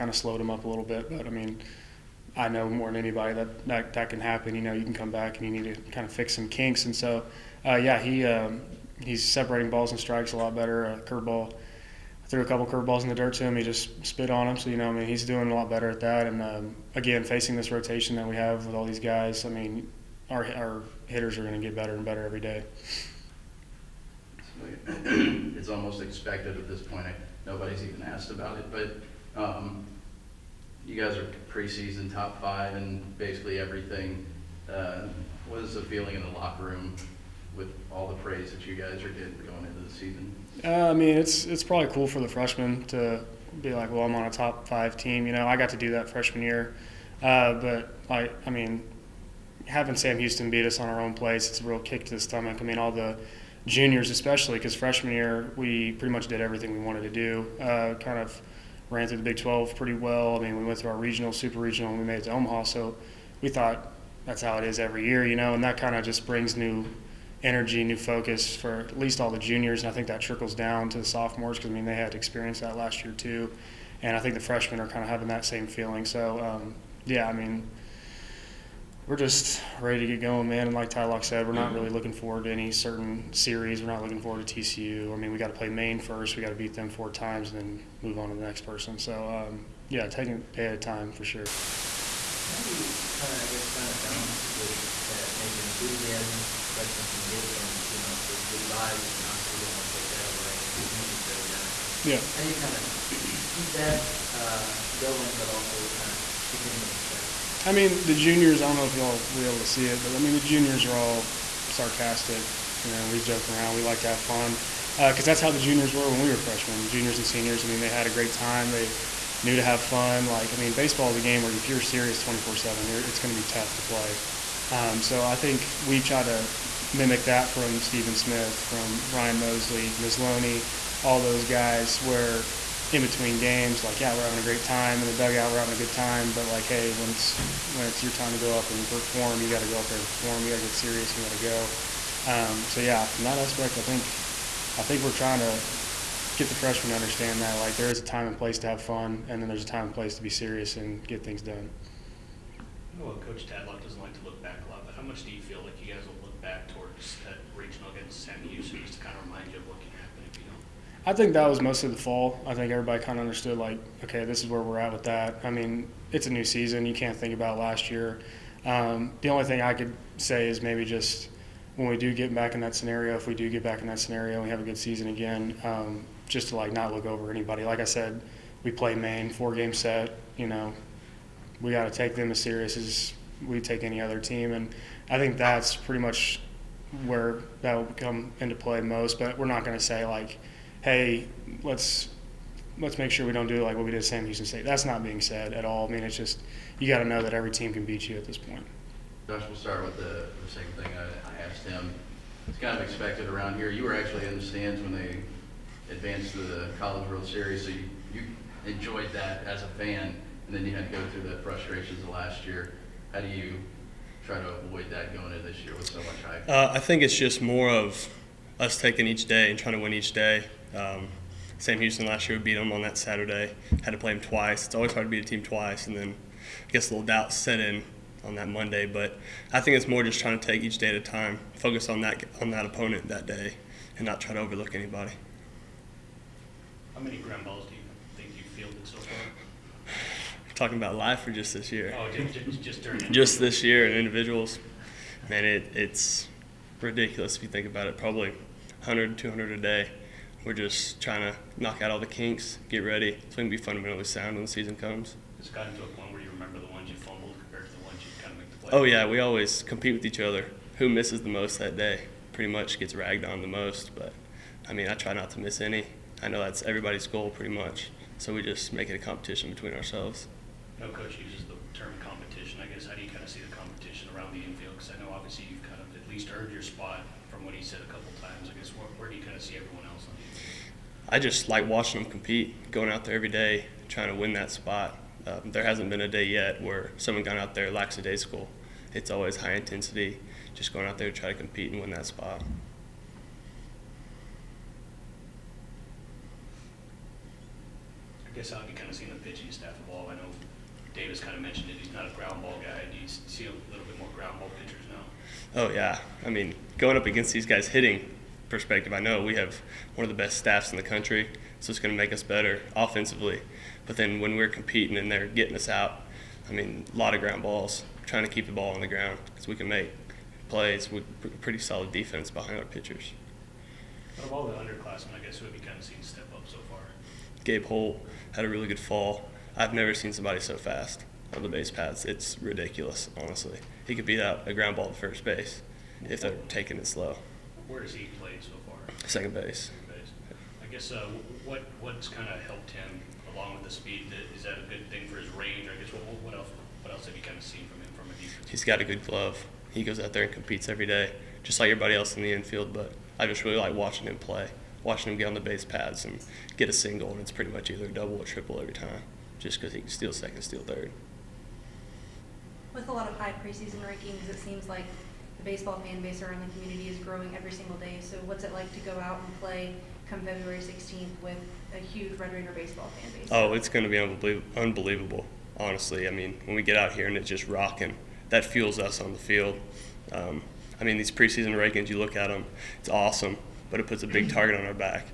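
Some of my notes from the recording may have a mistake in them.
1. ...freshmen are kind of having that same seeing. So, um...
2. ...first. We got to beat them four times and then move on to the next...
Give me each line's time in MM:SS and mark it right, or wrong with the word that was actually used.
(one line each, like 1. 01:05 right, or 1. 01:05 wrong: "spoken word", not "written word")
1. 01:14 wrong: "feeling", not "seeing"
2. 01:25 right.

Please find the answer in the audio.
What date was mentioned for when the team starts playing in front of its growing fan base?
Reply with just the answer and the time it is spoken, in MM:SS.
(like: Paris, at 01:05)
February 16th, at 06:10.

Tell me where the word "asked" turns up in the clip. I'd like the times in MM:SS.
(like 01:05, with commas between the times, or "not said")
00:28, 03:21.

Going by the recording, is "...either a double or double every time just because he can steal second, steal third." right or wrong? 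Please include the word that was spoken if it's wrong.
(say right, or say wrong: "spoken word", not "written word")
wrong: "triple", not "double".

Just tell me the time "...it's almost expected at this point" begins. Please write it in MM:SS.
00:25.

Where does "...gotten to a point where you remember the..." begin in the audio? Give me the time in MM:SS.
04:15.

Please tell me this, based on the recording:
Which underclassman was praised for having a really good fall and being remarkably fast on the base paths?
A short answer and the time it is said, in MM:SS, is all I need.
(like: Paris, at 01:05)
Gabe Holt, at 05:27.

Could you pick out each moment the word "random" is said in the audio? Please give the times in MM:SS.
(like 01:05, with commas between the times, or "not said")
not said.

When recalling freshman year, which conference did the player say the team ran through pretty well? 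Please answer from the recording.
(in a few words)
Big 12.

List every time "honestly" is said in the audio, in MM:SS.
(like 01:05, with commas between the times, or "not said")
05:33, 06:15.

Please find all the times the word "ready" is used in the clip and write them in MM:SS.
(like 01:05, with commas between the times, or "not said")
01:19, 04:12.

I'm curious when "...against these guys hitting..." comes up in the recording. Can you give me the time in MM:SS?
05:07.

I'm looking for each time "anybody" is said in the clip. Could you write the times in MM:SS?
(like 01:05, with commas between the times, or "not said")
00:02, 02:57, 03:54.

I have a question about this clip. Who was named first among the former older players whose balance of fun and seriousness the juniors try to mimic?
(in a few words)
Stephen Smith.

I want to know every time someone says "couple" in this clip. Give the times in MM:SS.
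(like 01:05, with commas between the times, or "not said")
00:12, 04:37.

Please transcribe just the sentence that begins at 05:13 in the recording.
But then when we're competing and they're getting us out, I mean a lot of ground balls.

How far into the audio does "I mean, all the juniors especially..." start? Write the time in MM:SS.
00:52.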